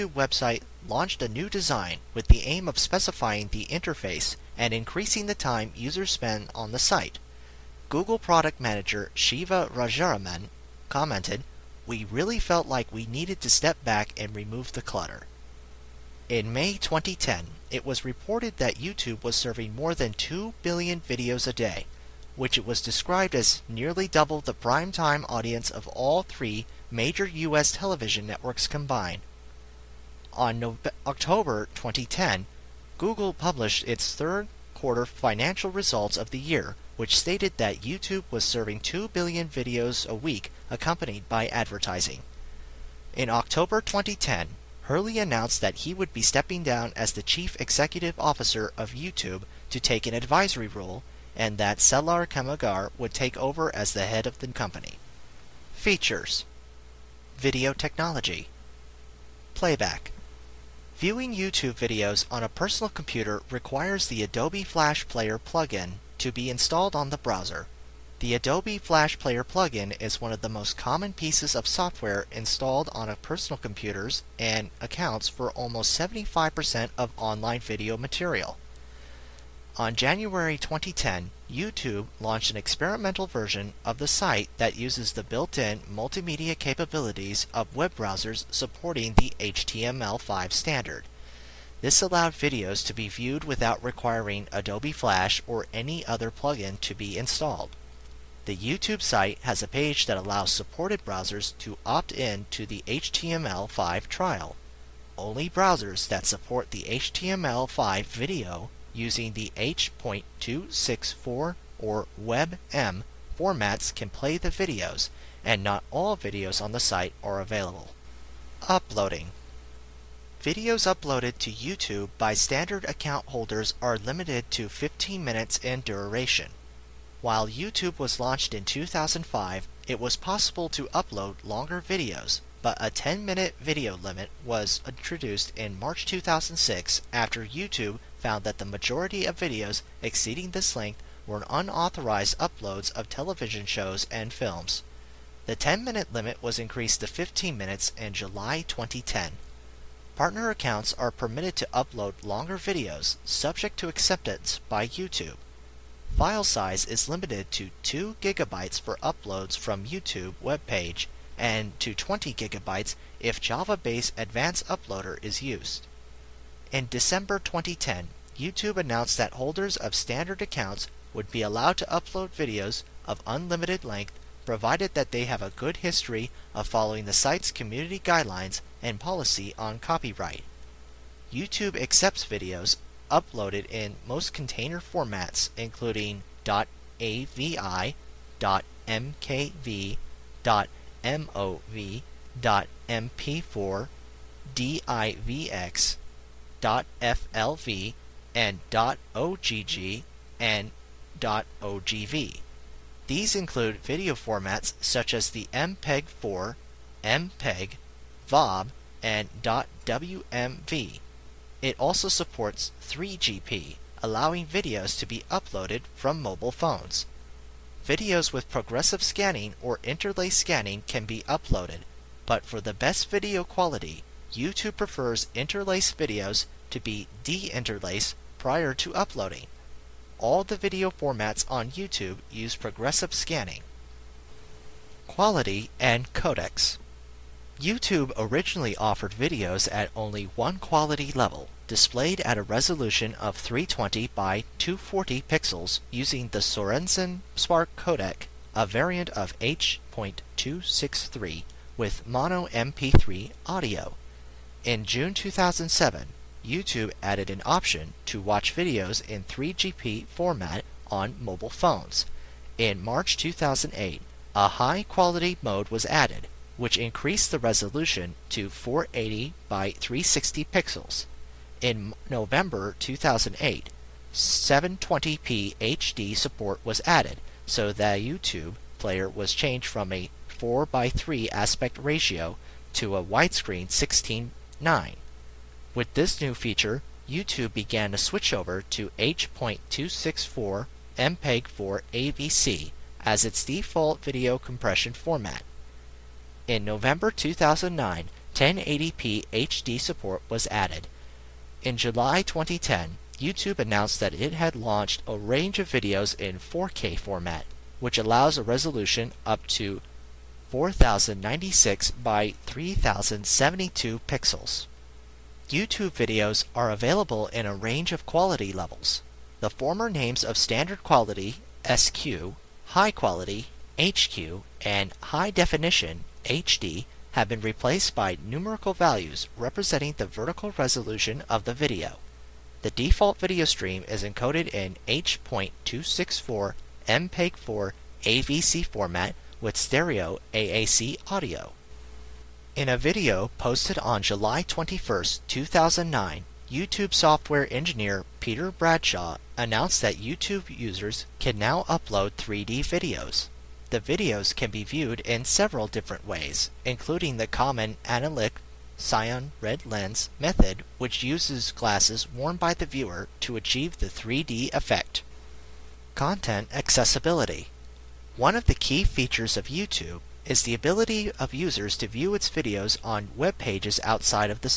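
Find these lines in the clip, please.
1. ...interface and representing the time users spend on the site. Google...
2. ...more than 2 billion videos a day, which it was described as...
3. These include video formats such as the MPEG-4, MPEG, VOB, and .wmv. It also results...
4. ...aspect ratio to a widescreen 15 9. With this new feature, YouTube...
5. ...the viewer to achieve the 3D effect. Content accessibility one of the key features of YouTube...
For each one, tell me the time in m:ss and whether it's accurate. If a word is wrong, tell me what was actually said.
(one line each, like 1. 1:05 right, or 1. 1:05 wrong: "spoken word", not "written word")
1. 0:03 wrong: "increasing", not "representing"
2. 0:19 right
3. 3:23 wrong: "supports", not "results"
4. 4:41 wrong: "16", not "15"
5. 6:02 right.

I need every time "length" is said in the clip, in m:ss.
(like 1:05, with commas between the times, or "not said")
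2:20, 2:53.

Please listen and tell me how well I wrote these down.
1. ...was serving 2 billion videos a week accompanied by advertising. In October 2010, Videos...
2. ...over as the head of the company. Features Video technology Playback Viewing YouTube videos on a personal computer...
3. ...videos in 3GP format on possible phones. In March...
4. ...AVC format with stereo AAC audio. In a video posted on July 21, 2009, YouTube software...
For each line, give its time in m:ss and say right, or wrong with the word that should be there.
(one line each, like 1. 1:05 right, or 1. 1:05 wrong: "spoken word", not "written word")
1. 0:38 wrong: "Hurley", not "Videos"
2. 0:53 right
3. 4:18 wrong: "mobile", not "possible"
4. 5:38 right.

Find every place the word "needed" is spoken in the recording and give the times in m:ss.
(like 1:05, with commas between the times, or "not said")
0:13.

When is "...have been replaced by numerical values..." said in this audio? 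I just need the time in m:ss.
5:27.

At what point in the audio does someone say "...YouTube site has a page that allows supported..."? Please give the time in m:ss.
1:38.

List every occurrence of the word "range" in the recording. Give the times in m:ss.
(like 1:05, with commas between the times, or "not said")
5:05, 5:17.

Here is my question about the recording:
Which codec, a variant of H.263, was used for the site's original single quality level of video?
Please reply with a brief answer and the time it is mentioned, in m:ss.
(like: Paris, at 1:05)
Sorensen Spark, at 4:06.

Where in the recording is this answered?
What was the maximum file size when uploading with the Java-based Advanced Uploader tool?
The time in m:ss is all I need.
2:41.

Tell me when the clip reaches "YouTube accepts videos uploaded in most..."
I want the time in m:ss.
3:01.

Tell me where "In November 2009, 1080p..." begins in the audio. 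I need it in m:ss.
4:56.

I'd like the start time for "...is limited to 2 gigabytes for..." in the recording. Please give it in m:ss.
2:36.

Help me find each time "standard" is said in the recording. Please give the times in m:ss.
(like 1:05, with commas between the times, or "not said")
1:30, 2:02, 2:49, 5:20.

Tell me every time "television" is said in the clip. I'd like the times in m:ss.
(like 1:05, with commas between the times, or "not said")
0:27, 2:23.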